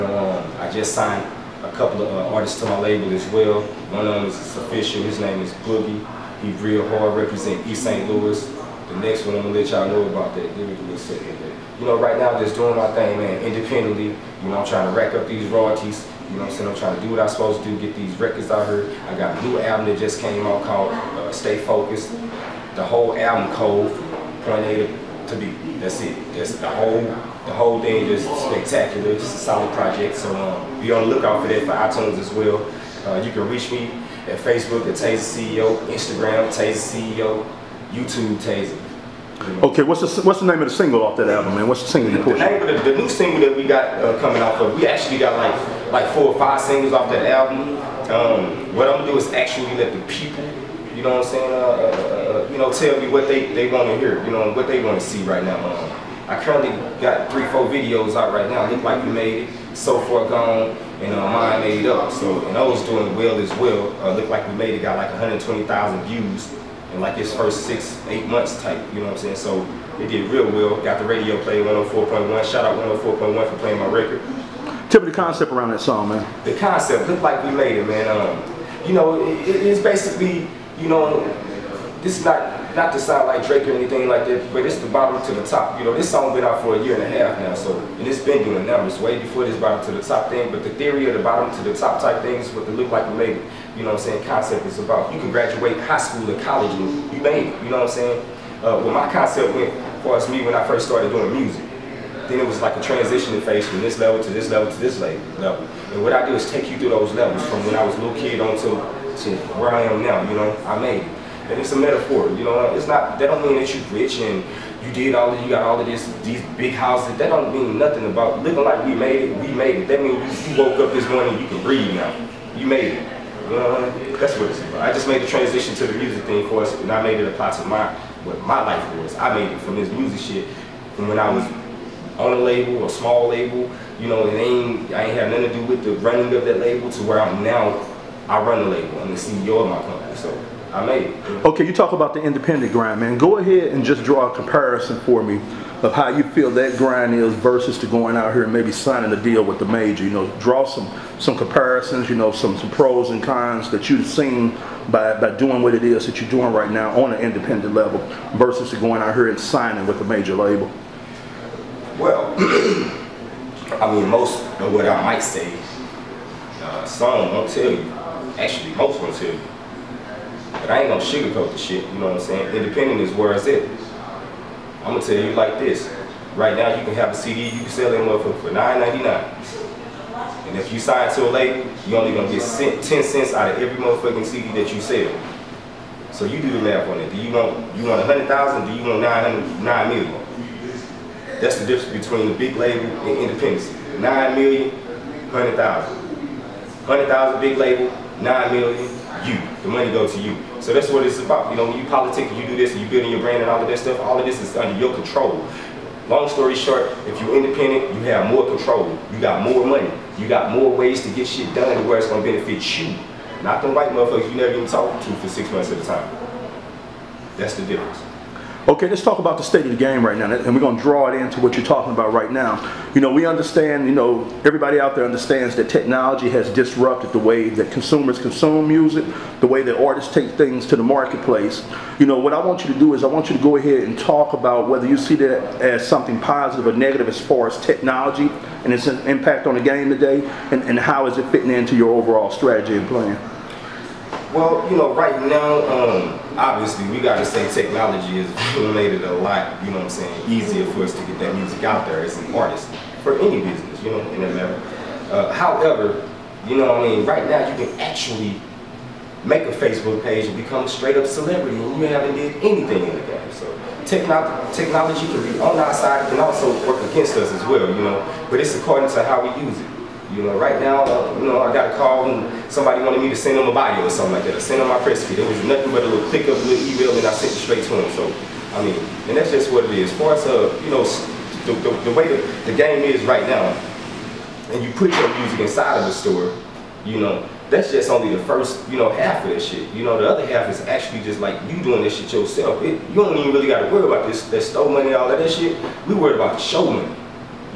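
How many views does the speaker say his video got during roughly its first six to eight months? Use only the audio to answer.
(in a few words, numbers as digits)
120,000.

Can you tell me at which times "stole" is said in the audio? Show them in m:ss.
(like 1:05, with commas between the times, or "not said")
4:54.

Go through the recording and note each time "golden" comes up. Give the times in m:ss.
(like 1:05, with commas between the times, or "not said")
not said.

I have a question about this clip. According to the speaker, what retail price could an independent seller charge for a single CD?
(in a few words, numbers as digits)
$9.99.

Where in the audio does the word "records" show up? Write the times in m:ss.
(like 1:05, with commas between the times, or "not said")
0:18, 1:13.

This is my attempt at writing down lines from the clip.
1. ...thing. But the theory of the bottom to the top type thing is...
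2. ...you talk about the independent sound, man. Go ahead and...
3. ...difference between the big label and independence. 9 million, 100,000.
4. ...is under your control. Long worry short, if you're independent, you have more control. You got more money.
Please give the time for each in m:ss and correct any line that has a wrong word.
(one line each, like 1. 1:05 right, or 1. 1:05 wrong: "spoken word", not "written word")
1. 1:30 right
2. 2:21 wrong: "grind", not "sound"
3. 3:11 right
4. 3:24 wrong: "story", not "worry".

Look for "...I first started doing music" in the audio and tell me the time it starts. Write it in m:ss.
1:40.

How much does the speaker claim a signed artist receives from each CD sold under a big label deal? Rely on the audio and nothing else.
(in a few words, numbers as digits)
10 cents.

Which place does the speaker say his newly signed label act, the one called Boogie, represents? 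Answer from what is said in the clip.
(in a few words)
East St. Louis.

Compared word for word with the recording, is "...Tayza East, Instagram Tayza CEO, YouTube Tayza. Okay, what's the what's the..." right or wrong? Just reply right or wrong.
wrong.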